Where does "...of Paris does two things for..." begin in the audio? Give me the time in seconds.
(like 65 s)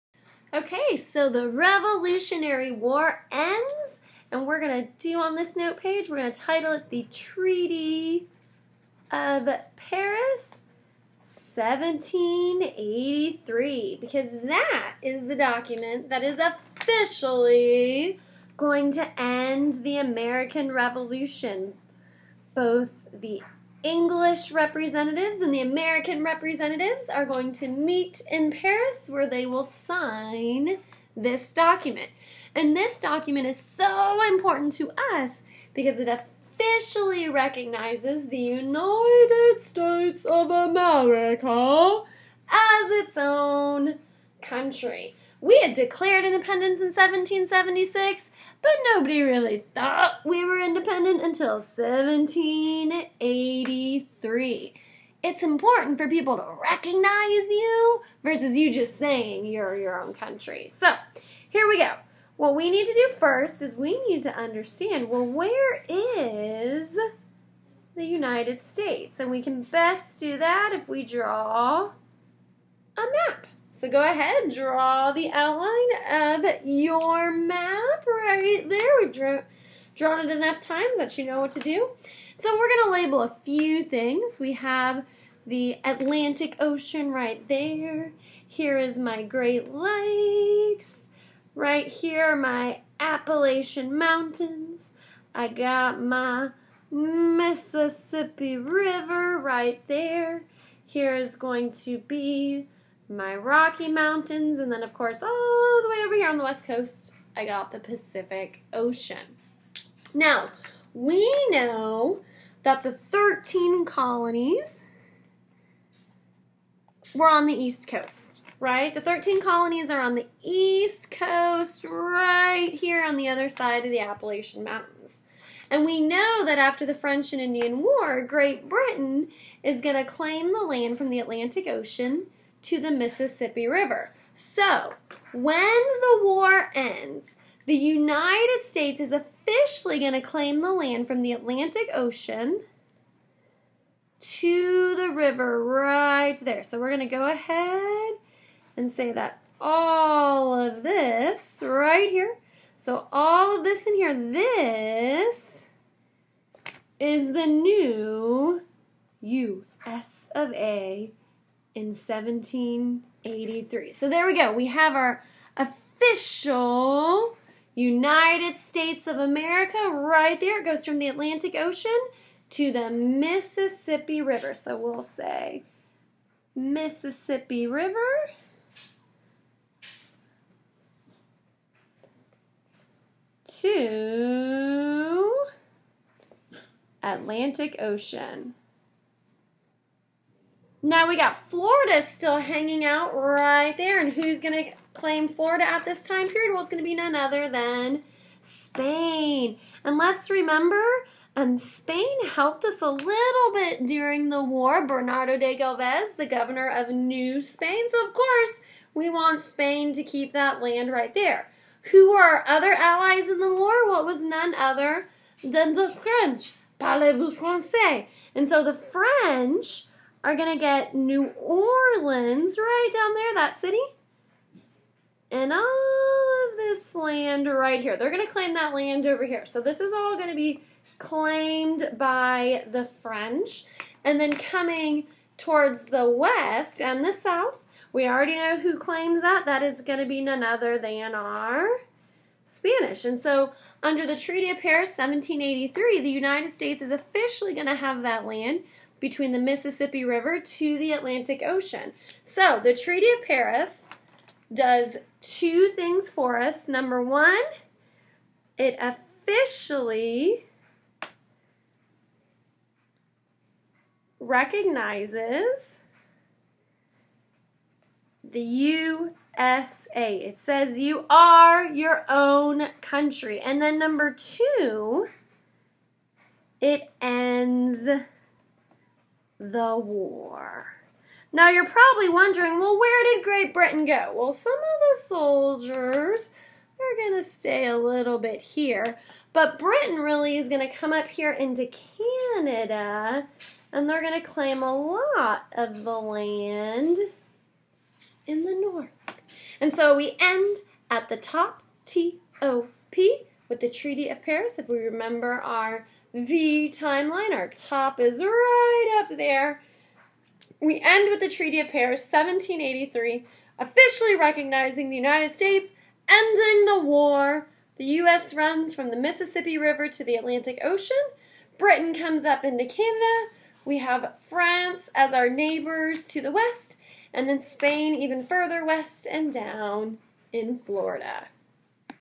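253 s.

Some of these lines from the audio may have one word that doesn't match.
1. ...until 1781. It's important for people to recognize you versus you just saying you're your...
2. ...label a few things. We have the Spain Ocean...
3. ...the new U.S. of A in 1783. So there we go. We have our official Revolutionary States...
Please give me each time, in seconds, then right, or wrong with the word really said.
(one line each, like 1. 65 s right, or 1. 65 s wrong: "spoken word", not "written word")
1. 51 s wrong: "1783", not "1781"
2. 82 s wrong: "Atlantic", not "Spain"
3. 157 s wrong: "United", not "Revolutionary".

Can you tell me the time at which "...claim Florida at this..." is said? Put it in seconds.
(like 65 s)
194 s.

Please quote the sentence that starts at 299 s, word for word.
And so we end at the top T O P with the Treaty of Paris.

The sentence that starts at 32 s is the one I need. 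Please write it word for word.
And this document is so important to us because it officially recognizes the United States of America as its own country.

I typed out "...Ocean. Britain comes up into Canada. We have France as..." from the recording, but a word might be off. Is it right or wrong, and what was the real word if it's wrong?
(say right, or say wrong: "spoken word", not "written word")
right.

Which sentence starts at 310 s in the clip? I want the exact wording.
We end with the Treaty of Paris, 1783, officially recognizing the United States, ending the war.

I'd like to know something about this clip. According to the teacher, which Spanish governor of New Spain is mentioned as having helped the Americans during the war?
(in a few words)
Bernardo de Galvez.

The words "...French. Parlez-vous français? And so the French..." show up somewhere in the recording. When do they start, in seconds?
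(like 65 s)
215 s.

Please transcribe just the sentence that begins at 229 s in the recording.
So this is all going to be claimed by the French.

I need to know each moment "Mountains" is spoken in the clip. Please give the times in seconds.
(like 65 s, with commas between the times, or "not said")
93 s, 103 s, 124 s.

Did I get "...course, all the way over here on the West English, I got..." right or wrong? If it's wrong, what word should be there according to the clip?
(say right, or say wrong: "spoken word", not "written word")
wrong: "Coast", not "English".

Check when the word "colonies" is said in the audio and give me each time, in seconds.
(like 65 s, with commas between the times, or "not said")
113 s, 119 s.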